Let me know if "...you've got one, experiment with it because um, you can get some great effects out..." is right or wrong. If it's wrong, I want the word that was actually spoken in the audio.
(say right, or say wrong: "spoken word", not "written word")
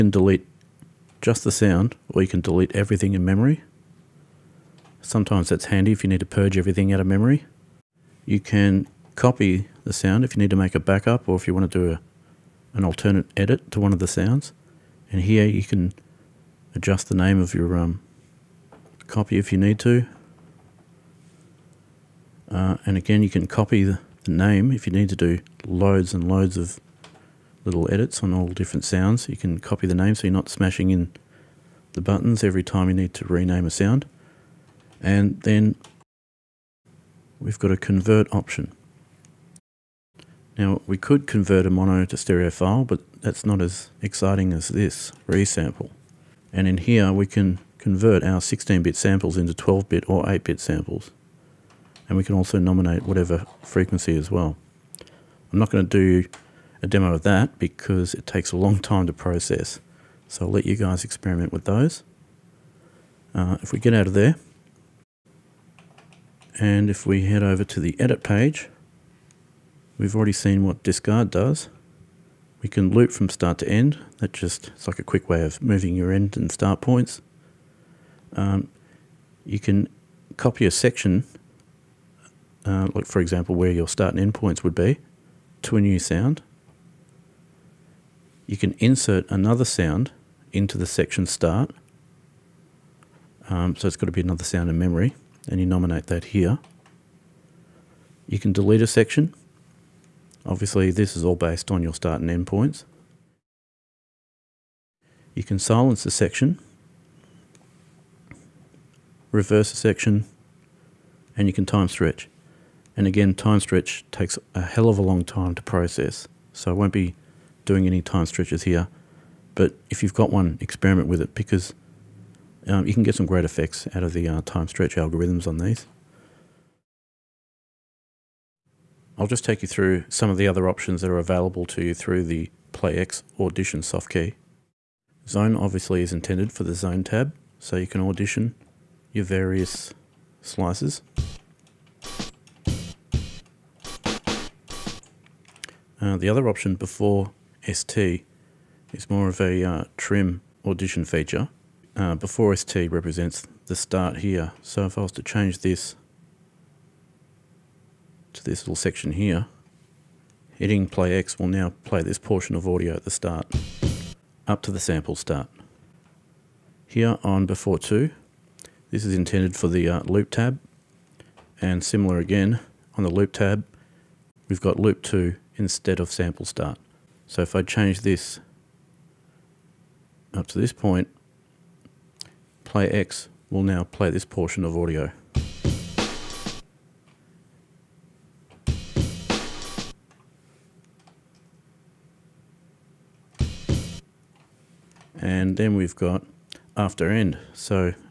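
right.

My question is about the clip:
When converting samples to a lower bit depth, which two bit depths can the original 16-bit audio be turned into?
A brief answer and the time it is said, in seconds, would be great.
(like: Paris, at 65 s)
12-bit or 8-bit, at 49 s.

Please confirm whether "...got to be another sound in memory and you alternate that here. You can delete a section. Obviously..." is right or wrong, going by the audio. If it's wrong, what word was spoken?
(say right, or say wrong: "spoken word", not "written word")
wrong: "nominate", not "alternate".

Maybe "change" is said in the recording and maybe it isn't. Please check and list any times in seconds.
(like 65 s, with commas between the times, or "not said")
155 s, 177 s.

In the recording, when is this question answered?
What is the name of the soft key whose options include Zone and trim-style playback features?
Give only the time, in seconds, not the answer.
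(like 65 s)
132 s.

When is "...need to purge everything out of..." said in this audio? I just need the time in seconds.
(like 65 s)
6 s.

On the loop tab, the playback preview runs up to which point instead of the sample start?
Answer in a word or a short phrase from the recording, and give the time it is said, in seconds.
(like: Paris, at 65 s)
Loop 2, at 174 s.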